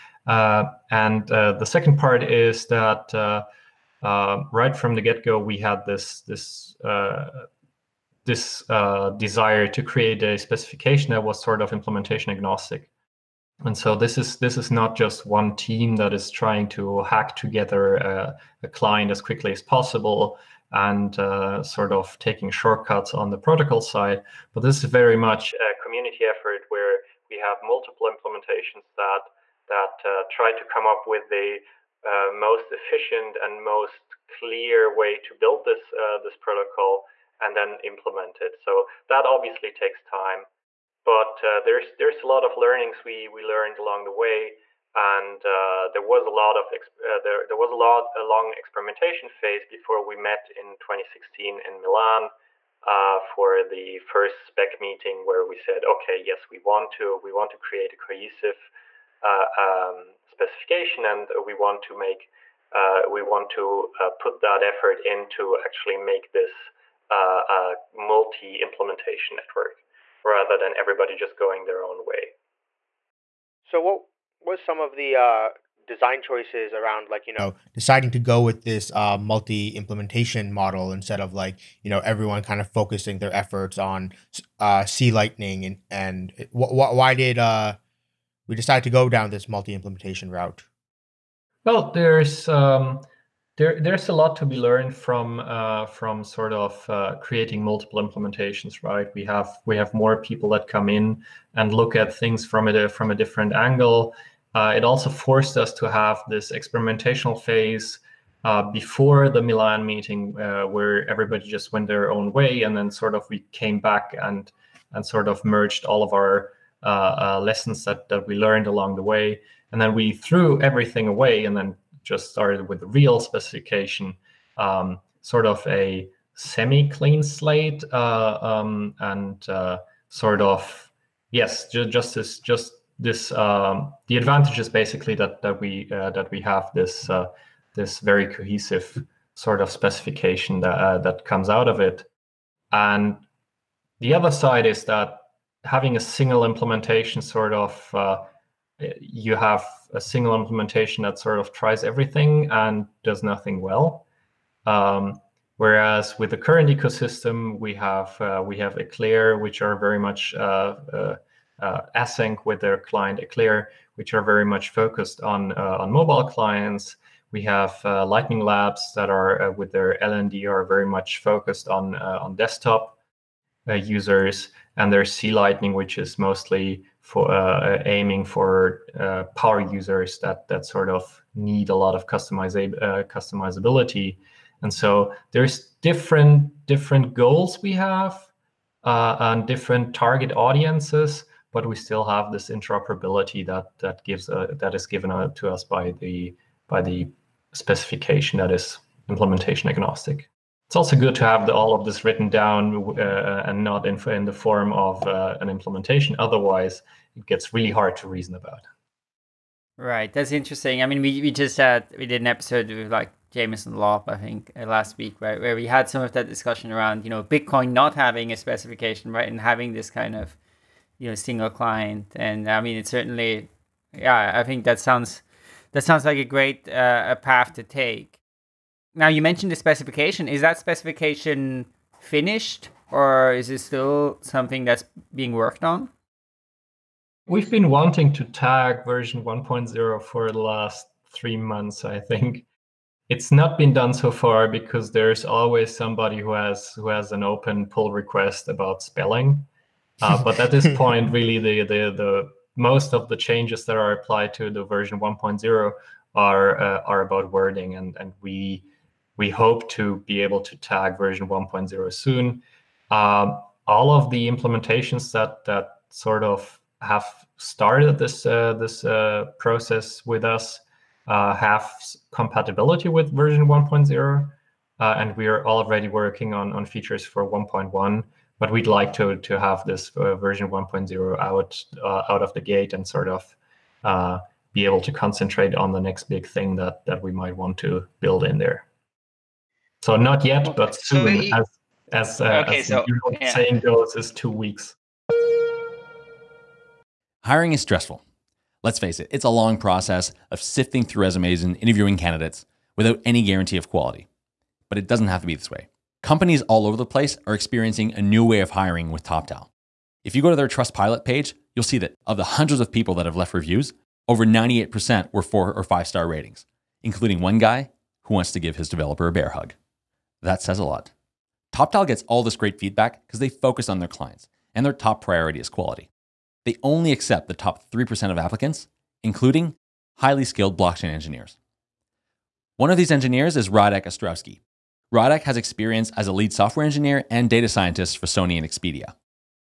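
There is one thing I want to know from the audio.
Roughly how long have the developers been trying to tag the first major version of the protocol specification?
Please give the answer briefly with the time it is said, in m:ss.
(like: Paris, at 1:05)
3 months, at 4:01.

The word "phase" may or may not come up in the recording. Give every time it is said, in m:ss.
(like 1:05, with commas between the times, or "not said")
0:49, 1:47.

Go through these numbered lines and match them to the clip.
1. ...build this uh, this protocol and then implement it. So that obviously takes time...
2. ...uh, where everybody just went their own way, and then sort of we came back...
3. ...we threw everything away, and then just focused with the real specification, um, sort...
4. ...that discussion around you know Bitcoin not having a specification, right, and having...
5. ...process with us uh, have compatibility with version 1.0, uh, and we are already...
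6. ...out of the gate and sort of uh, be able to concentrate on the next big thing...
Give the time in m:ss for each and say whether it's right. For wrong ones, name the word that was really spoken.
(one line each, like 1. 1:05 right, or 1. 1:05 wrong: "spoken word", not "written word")
1. 0:35 right
2. 1:50 right
3. 1:59 wrong: "started", not "focused"
4. 3:36 right
5. 4:29 right
6. 4:42 right.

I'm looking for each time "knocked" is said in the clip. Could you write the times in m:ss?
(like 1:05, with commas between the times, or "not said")
not said.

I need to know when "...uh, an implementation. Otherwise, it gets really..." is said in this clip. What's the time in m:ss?
3:25.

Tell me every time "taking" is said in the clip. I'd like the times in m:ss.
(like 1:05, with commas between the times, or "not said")
0:22.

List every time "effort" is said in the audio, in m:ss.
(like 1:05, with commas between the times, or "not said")
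0:26, 1:04, 1:23.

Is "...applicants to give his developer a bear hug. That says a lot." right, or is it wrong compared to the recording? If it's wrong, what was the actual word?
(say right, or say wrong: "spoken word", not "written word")
wrong: "wants", not "applicants".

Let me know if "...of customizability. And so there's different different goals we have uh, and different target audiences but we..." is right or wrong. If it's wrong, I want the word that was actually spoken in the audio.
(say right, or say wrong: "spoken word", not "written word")
right.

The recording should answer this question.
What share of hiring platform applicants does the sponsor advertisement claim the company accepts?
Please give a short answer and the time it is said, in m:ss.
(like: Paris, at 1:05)
top 3%, at 5:27.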